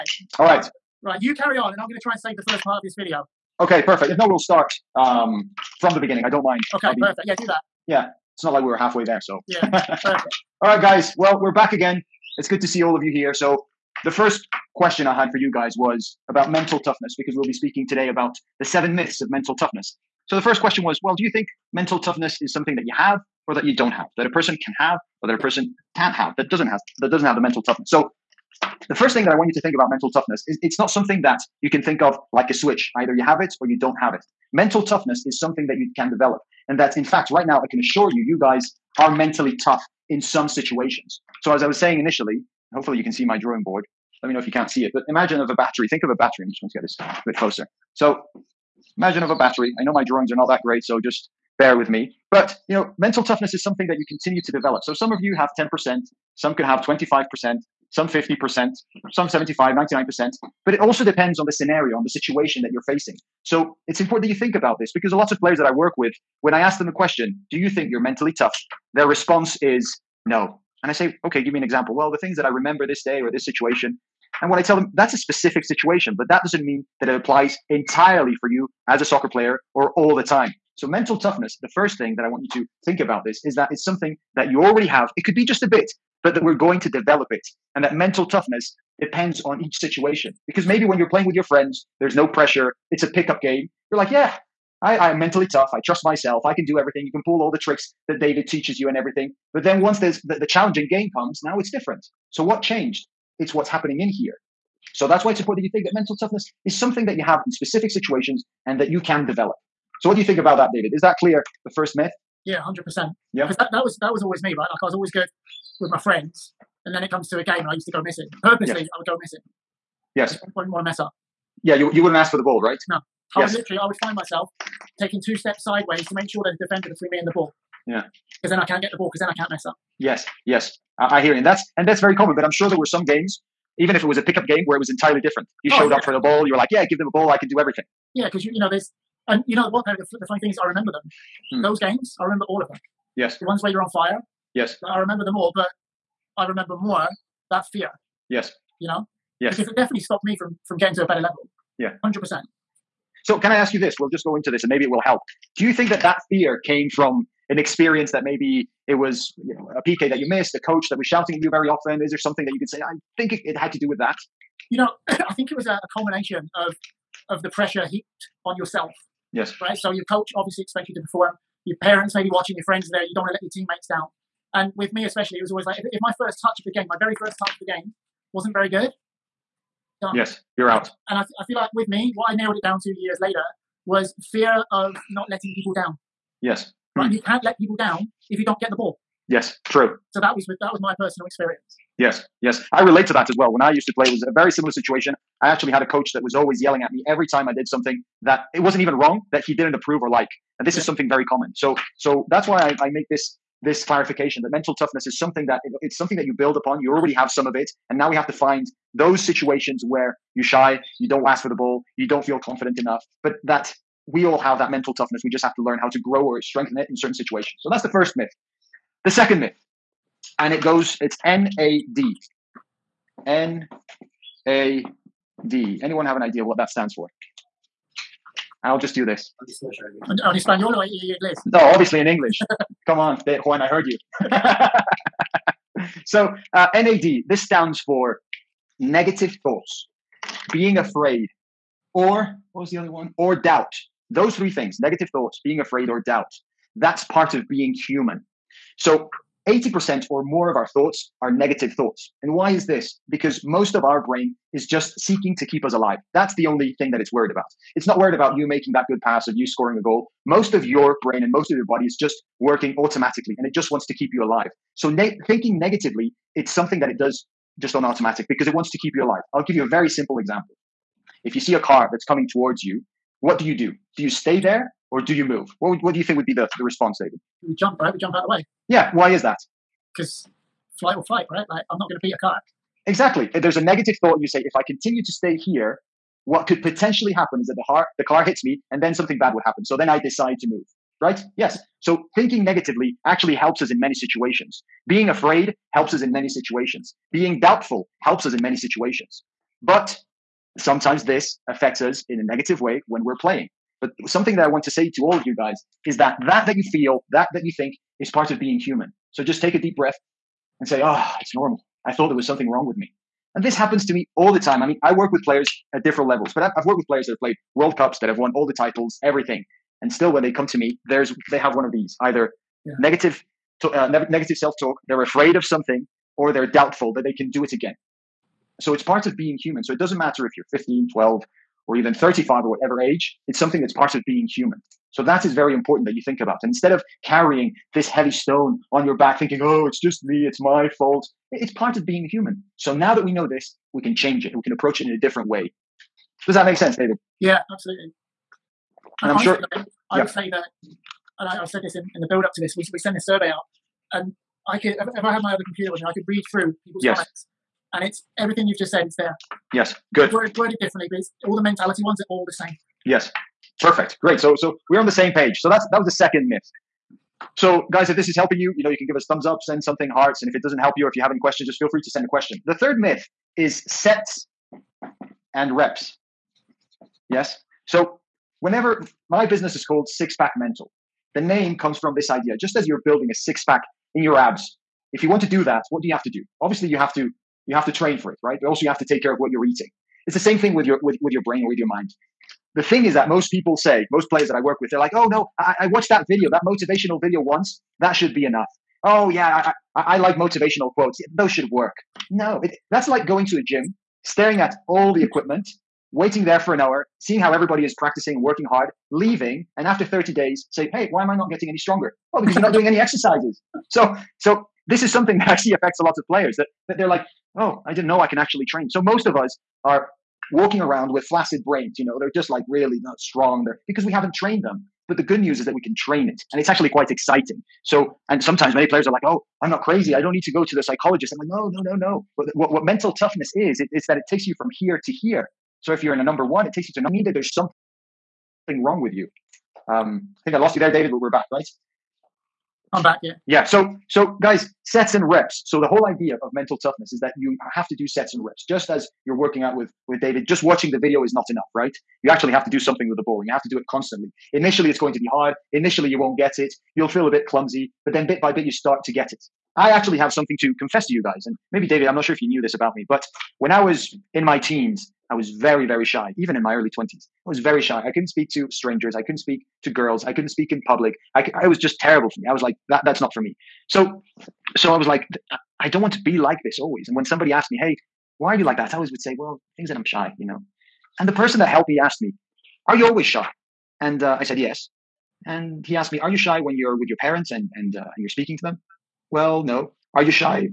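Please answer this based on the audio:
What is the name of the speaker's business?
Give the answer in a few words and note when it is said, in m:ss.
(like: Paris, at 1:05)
Six Pack Mental, at 6:19.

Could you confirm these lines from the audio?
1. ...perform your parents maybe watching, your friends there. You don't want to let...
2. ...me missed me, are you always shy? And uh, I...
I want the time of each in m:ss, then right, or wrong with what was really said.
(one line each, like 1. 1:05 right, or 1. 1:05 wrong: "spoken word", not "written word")
1. 2:51 right
2. 8:01 wrong: "asked", not "missed".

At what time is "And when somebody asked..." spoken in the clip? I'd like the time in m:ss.
7:56.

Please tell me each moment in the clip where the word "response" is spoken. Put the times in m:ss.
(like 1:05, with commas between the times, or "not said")
1:09, 4:36.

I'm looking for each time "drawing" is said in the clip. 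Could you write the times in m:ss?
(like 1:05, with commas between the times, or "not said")
0:43, 0:50.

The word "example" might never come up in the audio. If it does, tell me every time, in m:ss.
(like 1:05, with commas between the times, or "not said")
1:11, 4:30.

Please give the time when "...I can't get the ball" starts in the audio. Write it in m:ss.
2:08.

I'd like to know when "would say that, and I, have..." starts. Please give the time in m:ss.
5:50.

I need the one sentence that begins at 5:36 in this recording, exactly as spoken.
And instead of carrying this heavy stone on your back thinking, oh, it's just me, it's my fault.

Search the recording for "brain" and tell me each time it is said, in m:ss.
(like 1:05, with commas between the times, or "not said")
4:14, 4:21, 6:31, 7:01.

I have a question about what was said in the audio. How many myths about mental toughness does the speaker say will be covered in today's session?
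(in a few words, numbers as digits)
7.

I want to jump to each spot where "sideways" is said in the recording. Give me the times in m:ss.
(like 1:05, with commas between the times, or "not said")
2:05.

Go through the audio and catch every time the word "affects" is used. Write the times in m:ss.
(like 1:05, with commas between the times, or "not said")
5:01, 6:55.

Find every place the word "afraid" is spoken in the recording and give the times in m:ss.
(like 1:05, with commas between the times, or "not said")
4:00, 4:05, 4:55, 5:25.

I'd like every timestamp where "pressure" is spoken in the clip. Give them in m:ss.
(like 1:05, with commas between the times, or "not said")
1:32, 2:47.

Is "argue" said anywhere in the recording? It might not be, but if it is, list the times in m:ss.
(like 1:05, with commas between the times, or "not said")
not said.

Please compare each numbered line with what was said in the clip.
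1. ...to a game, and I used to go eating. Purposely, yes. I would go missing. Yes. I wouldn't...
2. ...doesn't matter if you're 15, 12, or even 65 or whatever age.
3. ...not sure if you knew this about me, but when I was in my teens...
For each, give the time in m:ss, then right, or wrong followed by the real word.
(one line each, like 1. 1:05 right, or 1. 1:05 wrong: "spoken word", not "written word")
1. 1:57 wrong: "missing", not "eating"
2. 5:29 wrong: "35", not "65"
3. 7:41 right.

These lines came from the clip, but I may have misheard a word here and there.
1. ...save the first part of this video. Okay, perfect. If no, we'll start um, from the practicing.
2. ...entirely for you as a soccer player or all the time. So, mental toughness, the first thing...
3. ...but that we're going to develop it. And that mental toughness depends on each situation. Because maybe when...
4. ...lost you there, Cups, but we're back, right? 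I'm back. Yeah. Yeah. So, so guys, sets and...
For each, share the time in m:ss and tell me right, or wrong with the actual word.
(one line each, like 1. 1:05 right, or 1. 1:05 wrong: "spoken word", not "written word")
1. 0:02 wrong: "beginning", not "practicing"
2. 1:17 right
3. 1:26 right
4. 7:20 wrong: "David", not "Cups".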